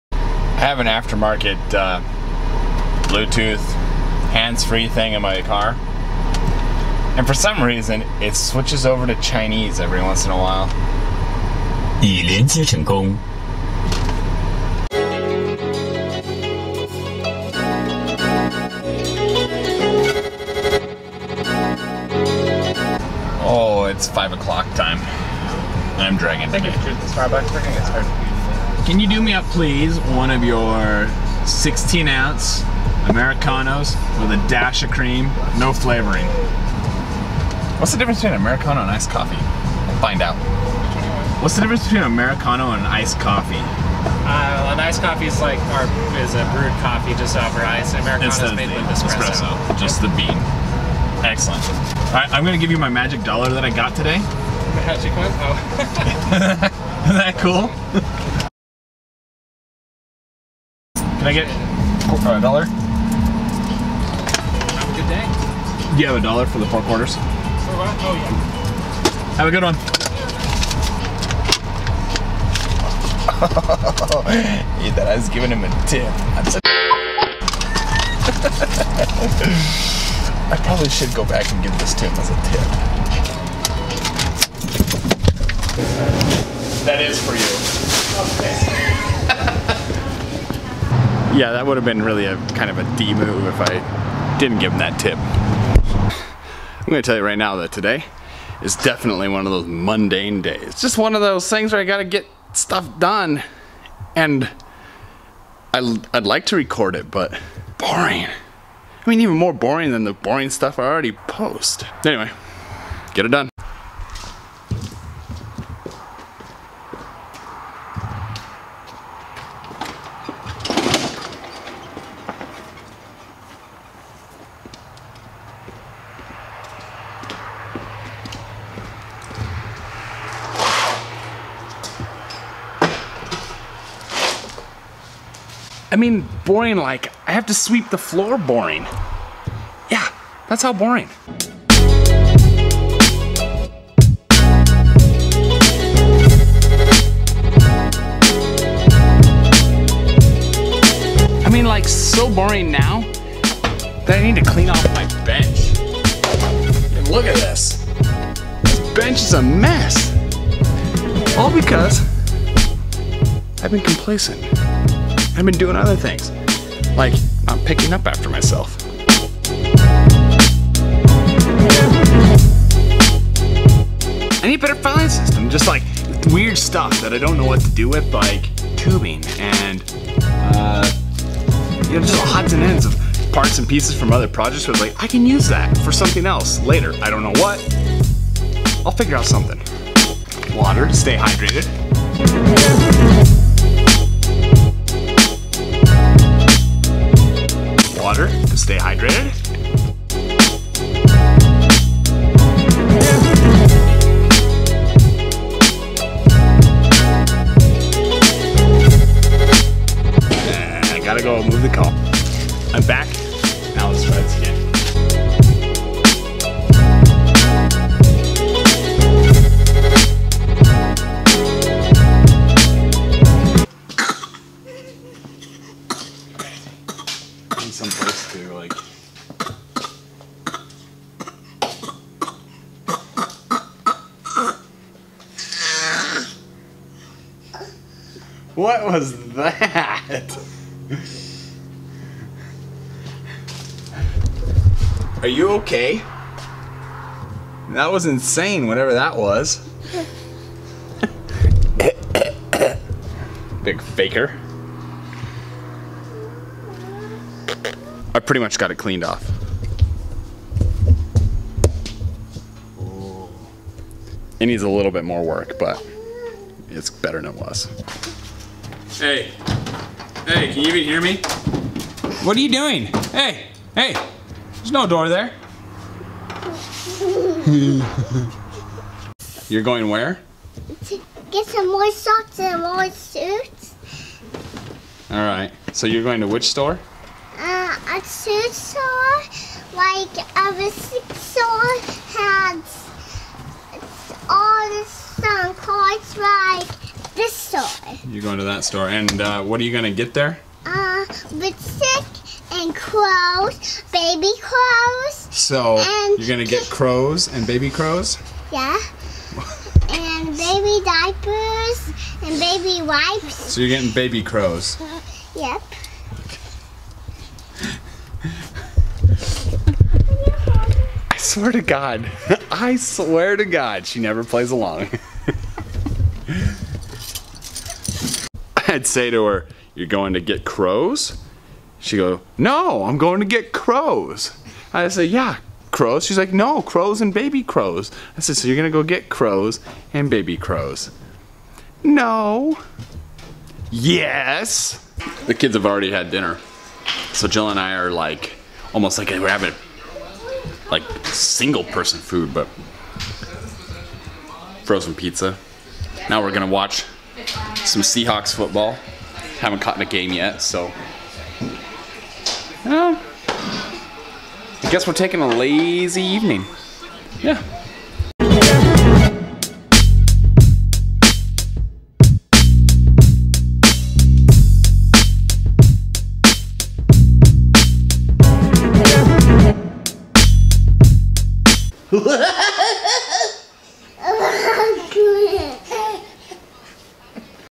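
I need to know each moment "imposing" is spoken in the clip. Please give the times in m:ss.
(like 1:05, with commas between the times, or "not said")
not said.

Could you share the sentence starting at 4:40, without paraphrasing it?
To get some more socks and more suits.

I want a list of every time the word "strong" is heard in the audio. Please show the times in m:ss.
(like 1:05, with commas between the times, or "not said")
not said.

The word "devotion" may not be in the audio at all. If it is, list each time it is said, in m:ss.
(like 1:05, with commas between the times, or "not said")
not said.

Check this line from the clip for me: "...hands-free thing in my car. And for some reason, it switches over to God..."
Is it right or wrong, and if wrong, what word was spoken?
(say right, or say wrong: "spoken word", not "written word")
wrong: "Chinese", not "God".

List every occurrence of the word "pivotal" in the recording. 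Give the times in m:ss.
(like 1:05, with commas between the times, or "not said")
not said.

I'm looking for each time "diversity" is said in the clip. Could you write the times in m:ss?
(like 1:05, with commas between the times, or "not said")
not said.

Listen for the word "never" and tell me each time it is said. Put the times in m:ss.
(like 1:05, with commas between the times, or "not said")
5:23.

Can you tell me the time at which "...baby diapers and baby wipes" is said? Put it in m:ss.
5:10.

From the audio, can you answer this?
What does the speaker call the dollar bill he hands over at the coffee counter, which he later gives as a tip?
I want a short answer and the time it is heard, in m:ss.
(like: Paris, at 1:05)
Magic dollar, at 0:52.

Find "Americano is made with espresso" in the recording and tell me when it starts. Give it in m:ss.
0:47.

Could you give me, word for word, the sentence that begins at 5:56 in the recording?
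Now we're gonna watch some Seahawks football.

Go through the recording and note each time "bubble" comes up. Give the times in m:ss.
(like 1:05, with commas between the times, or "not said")
not said.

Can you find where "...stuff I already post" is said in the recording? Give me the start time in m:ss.
1:50.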